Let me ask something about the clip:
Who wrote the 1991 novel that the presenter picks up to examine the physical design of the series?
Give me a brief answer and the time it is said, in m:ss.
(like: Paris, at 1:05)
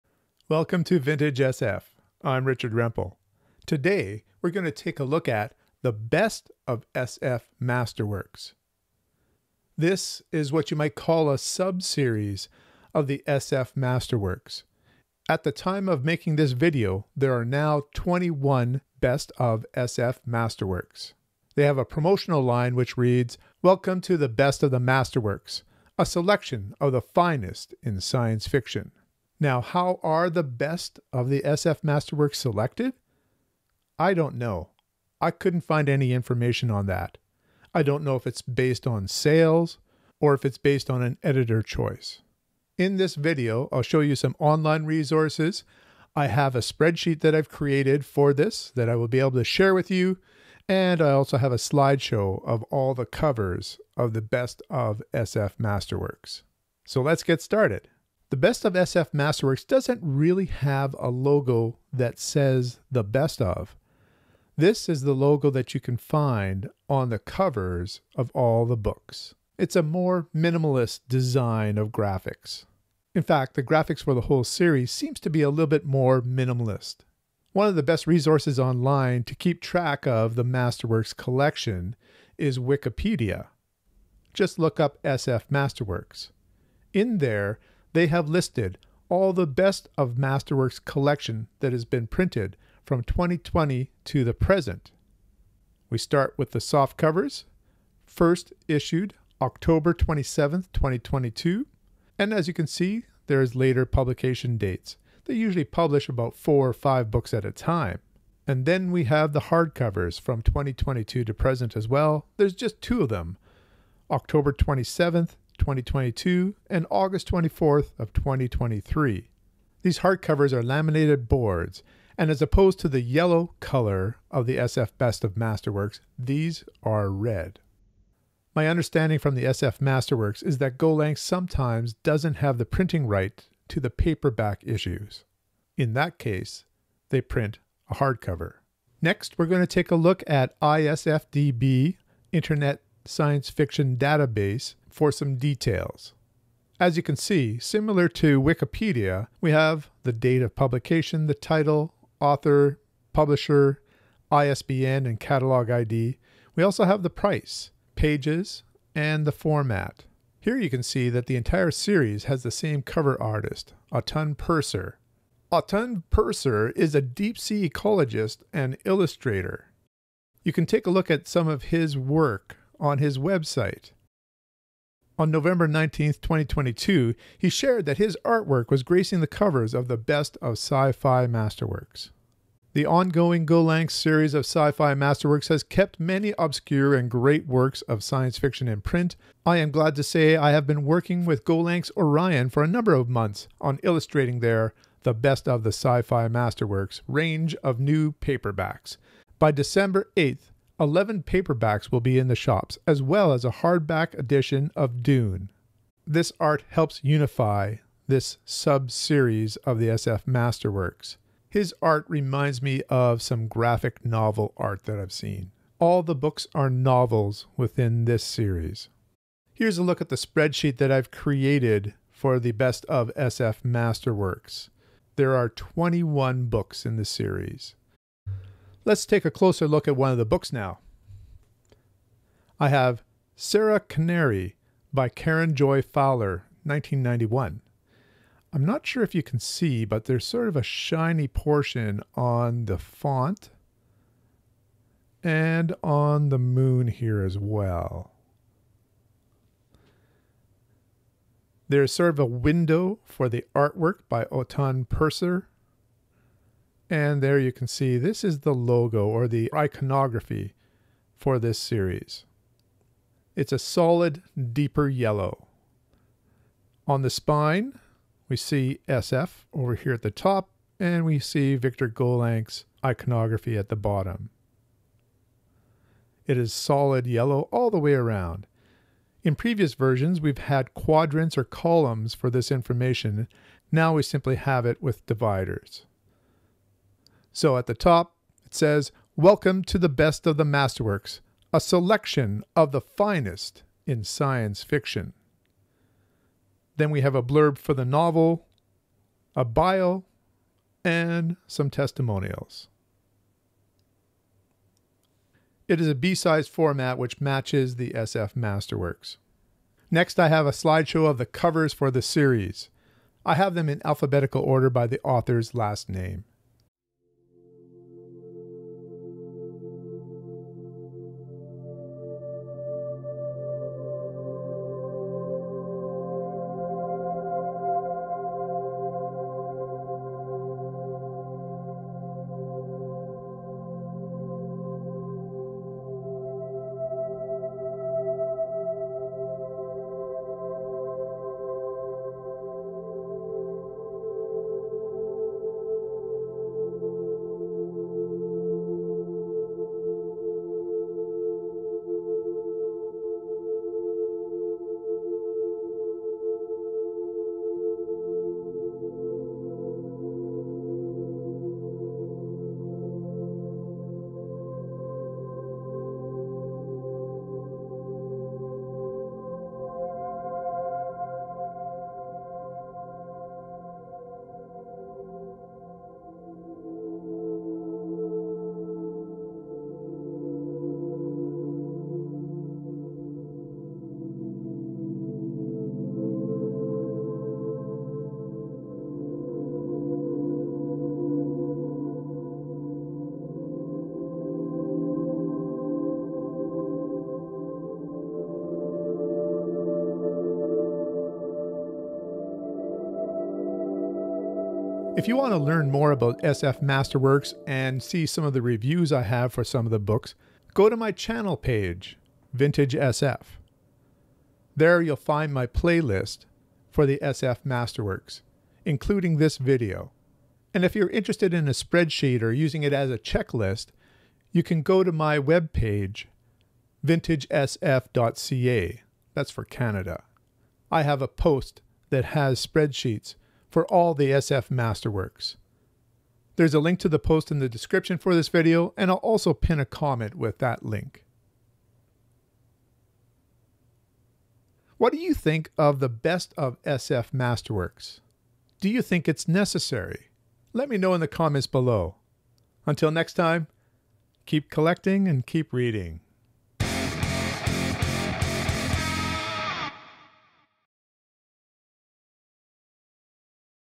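Karen Joy Fowler, at 3:55.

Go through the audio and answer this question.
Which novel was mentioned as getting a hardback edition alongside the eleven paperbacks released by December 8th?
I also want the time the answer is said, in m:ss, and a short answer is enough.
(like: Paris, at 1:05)
Dune, at 3:25.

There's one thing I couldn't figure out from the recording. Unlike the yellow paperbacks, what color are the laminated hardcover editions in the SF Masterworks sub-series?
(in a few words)
Red.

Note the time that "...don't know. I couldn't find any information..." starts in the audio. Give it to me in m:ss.
0:34.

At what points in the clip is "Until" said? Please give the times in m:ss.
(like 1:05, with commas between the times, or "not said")
7:32.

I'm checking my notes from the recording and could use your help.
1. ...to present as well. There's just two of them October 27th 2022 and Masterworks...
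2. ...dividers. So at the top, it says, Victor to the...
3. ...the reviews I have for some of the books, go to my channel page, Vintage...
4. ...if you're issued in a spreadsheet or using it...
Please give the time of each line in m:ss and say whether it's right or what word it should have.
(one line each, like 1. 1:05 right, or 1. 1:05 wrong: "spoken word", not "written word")
1. 1:51 wrong: "August", not "Masterworks"
2. 4:45 wrong: "Welcome", not "Victor"
3. 6:48 right
4. 7:00 wrong: "interested", not "issued".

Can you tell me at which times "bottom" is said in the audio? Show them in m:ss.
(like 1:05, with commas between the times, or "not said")
4:33.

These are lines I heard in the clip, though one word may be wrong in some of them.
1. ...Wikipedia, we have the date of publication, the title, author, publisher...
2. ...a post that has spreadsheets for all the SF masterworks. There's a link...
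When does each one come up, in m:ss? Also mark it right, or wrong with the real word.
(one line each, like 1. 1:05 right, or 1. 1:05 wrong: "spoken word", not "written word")
1. 2:28 right
2. 7:11 right.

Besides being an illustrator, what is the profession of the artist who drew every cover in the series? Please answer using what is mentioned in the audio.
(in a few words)
Deep sea ecologist.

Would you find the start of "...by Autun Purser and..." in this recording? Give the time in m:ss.
4:14.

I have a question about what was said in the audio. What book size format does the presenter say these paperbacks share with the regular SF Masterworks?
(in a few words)
B-size.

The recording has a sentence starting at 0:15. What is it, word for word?
At the time of making this video, there are now 21 best of SF masterworks.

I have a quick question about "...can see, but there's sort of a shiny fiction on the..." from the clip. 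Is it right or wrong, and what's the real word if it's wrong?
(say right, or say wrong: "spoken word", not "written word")
wrong: "portion", not "fiction".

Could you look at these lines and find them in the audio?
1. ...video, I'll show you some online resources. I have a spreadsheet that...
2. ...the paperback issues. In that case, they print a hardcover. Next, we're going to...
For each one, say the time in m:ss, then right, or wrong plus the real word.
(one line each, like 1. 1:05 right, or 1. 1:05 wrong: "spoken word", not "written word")
1. 0:43 right
2. 2:13 right.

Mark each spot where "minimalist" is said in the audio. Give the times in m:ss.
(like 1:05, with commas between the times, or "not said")
1:10, 1:16.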